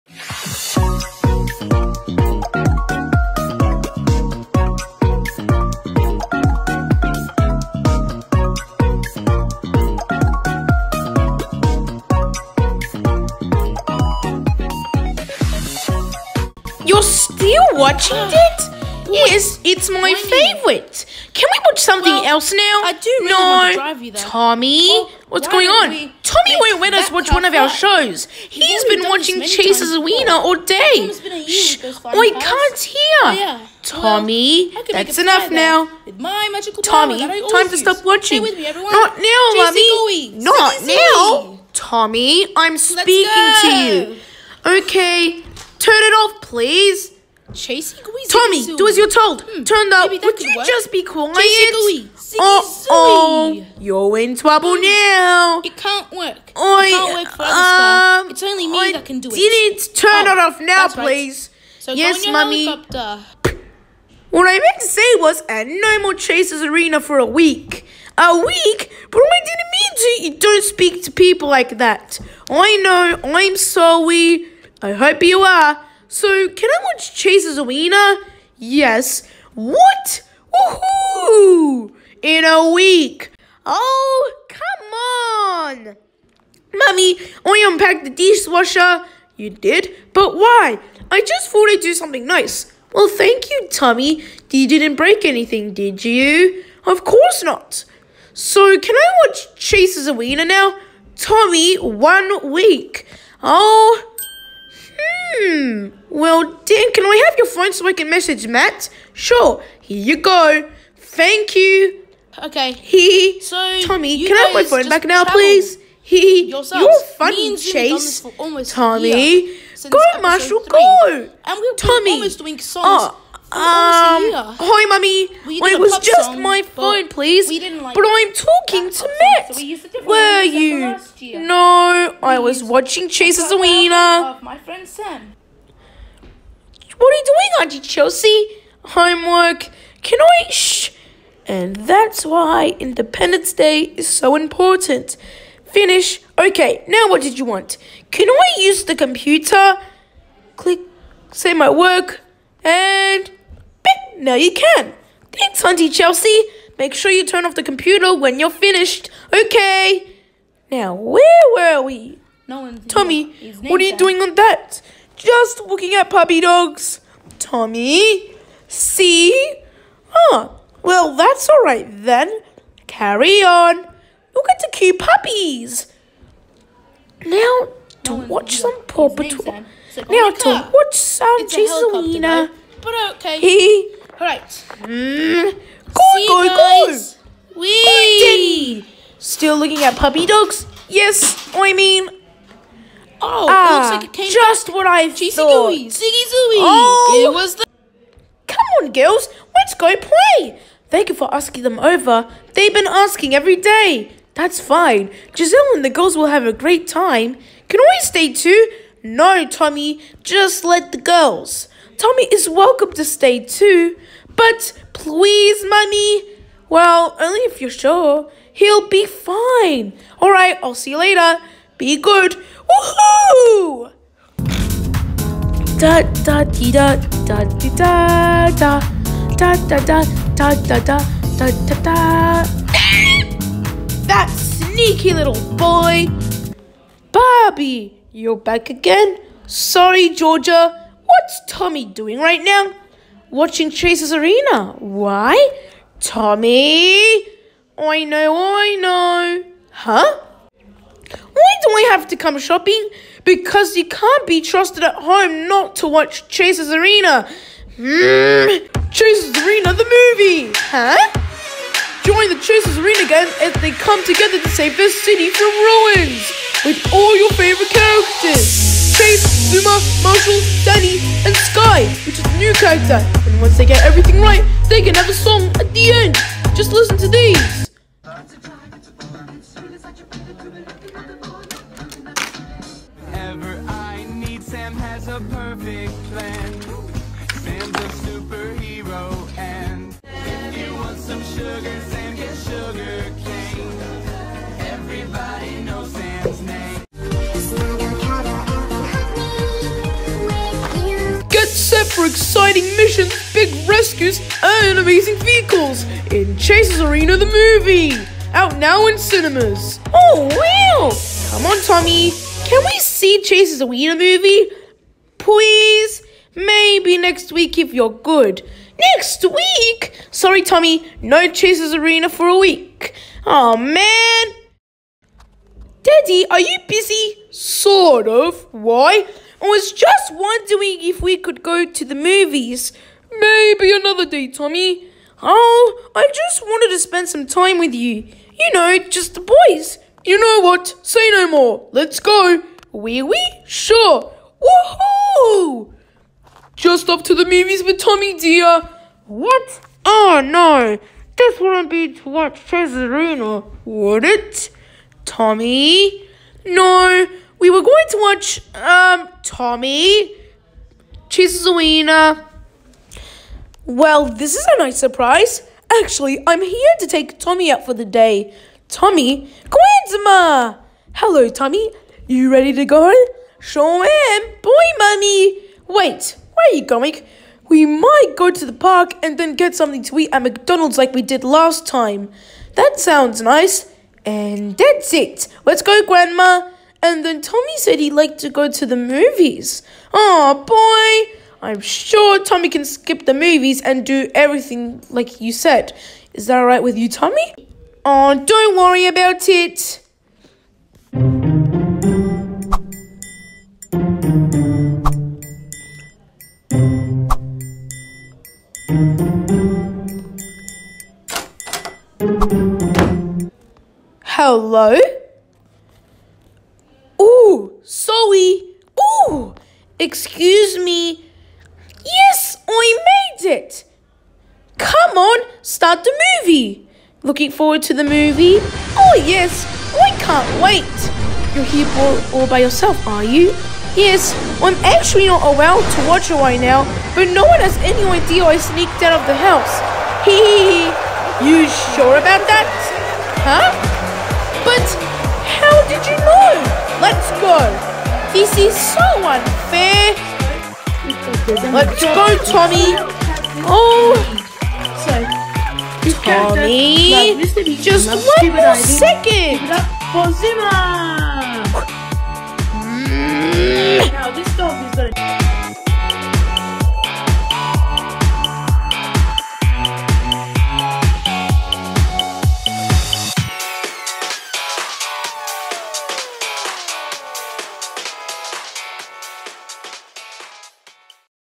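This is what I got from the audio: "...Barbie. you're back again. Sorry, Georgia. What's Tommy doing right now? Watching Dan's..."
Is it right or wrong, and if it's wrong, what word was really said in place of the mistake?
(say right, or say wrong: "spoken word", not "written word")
wrong: "Chase", not "Dan".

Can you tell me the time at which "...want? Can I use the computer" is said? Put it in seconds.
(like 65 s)
147 s.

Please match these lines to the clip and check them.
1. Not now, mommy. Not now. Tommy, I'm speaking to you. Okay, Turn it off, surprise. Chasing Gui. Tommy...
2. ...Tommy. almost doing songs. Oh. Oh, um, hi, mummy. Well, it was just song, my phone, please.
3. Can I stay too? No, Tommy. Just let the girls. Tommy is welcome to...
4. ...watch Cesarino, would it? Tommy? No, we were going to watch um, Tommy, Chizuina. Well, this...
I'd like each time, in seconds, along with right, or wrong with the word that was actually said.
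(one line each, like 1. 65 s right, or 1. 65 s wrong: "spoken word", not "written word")
1. 38 s wrong: "please", not "surprise"
2. 121 s right
3. 207 s right
4. 352 s right.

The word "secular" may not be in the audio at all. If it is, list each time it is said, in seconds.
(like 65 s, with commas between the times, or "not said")
not said.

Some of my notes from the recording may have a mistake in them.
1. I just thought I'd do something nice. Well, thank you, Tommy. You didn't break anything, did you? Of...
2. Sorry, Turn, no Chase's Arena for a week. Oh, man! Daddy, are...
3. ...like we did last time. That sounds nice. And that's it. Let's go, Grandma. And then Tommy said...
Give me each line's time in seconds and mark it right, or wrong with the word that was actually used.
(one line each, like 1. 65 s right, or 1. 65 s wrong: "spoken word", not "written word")
1. 91 s right
2. 320 s wrong: "Tommy", not "Turn"
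3. 380 s right.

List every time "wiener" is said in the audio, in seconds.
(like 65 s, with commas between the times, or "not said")
77 s, 100 s, 133 s.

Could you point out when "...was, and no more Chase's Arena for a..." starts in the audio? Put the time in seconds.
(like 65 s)
65 s.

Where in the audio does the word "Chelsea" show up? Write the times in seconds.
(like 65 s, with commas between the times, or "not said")
137 s, 155 s.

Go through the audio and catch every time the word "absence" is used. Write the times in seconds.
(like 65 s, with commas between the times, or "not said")
not said.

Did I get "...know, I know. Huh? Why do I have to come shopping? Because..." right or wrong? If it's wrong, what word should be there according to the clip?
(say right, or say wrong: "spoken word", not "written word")
right.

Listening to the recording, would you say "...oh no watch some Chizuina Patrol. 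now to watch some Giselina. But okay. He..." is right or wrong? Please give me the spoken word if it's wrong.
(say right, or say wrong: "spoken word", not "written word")
wrong: "Paw", not "Chizuina".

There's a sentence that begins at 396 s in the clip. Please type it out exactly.
Is that alright with you, Tommy?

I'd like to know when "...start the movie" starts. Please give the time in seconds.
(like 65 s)
425 s.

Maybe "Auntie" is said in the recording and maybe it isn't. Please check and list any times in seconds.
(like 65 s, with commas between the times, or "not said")
137 s, 155 s.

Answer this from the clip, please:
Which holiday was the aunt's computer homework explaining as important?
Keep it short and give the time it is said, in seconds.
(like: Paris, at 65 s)
Independence Day, at 142 s.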